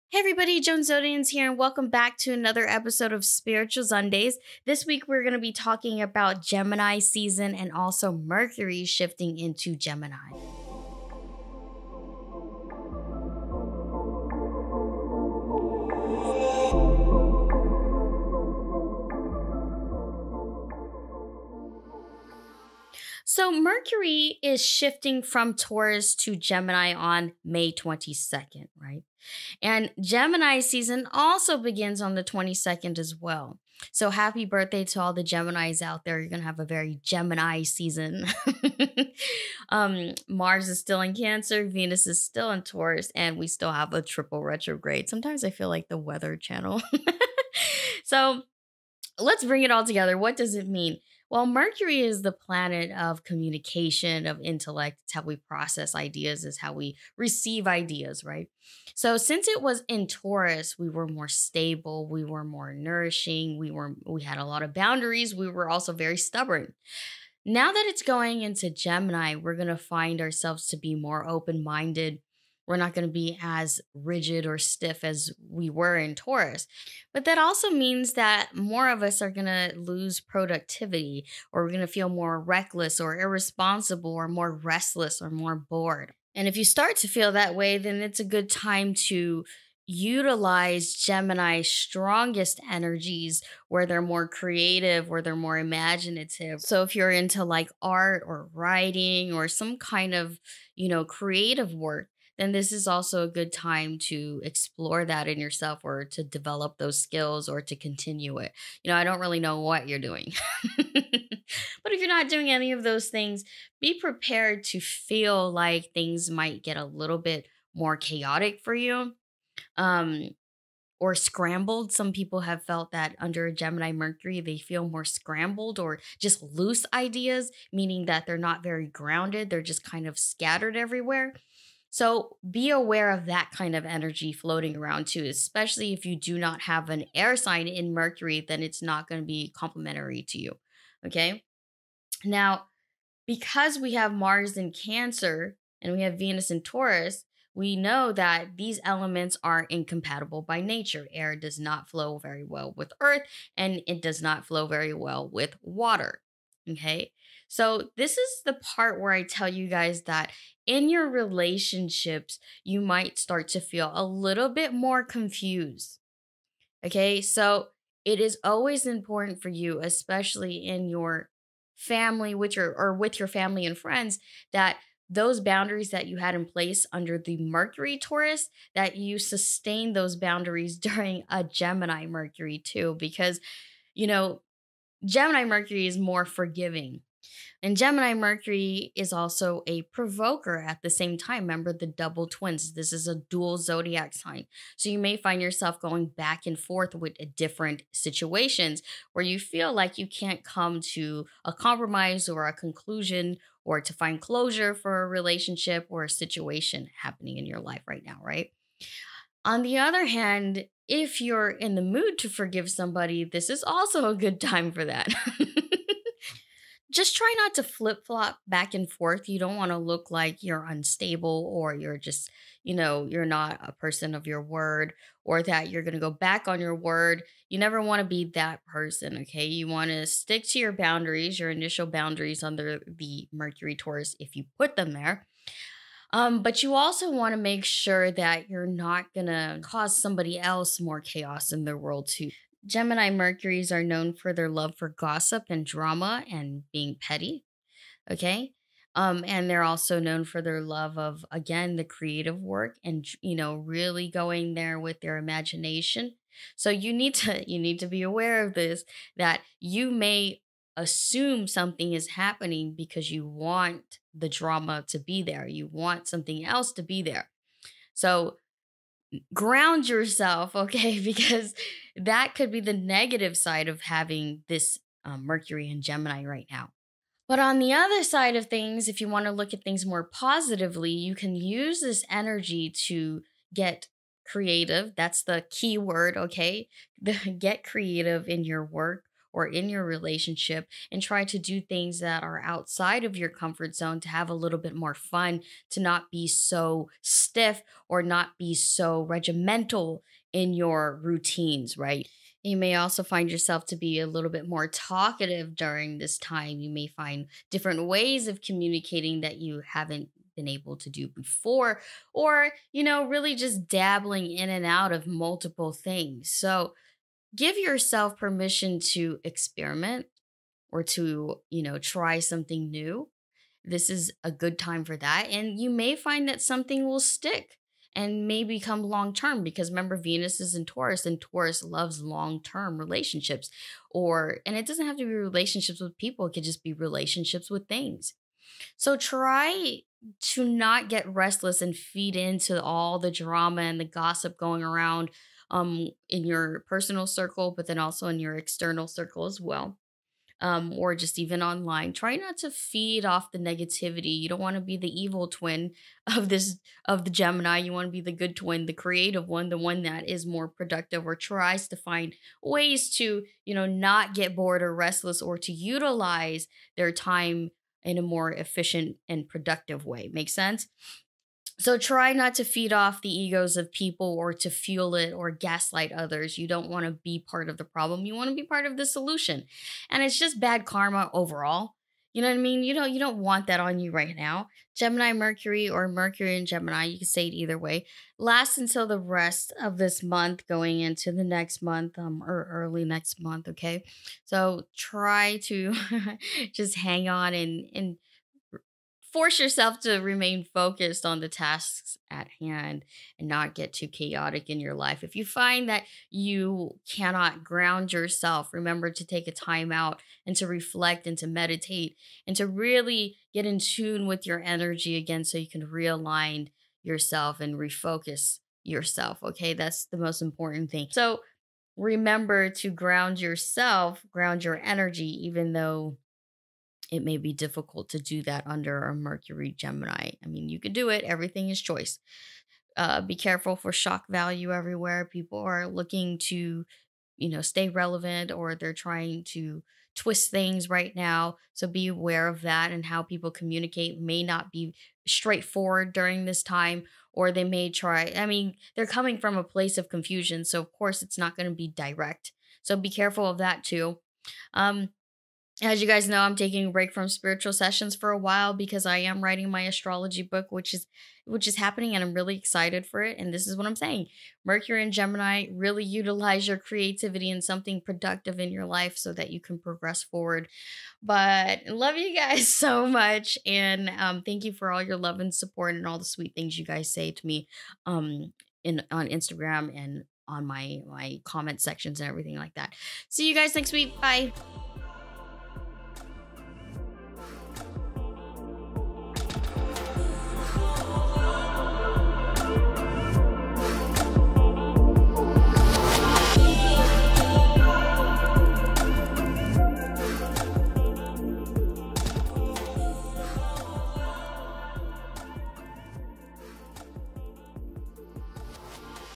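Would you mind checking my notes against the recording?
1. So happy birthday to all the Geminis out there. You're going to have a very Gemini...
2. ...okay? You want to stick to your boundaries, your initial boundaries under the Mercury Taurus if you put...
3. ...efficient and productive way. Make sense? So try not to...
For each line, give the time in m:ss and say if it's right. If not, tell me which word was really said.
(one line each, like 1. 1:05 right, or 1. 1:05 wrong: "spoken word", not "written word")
1. 0:33 right
2. 3:49 right
3. 6:08 right.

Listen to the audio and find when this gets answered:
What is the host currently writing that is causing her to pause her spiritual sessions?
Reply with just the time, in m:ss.
7:39.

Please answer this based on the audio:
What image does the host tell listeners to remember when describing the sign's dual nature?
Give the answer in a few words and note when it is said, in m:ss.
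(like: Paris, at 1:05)
the double twins, at 3:11.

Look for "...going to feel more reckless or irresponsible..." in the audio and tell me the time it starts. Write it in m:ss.
1:21.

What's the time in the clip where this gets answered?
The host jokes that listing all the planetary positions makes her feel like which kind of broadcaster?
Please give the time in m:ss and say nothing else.
0:45.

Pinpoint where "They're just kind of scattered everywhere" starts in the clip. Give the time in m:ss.
2:09.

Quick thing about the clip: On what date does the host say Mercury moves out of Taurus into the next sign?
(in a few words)
May 22nd.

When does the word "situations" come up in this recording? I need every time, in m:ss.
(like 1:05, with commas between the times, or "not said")
3:17, 3:26.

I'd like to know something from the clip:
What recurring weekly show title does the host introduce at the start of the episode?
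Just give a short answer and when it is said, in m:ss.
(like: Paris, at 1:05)
Spiritual Zundayz, at 0:03.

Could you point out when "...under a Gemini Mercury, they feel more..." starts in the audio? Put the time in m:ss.
2:03.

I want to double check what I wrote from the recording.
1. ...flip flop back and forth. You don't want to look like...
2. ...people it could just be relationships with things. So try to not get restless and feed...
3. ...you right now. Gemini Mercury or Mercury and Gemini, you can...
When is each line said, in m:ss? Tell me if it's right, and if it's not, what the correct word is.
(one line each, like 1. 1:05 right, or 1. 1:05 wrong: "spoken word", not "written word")
1. 3:37 right
2. 5:35 right
3. 6:23 right.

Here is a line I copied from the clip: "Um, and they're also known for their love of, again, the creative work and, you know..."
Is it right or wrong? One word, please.
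right.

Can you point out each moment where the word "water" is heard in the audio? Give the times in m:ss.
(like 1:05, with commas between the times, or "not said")
2:35.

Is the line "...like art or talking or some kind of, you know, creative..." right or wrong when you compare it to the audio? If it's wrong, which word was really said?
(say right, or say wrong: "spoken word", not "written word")
wrong: "writing", not "talking".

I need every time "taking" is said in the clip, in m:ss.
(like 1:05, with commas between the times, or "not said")
7:36.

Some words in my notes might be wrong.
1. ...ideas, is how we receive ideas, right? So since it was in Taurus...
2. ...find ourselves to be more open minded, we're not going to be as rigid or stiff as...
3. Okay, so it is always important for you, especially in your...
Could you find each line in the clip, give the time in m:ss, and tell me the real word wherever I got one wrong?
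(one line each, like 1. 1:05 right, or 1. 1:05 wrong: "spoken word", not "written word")
1. 0:55 right
2. 1:09 right
3. 2:46 right.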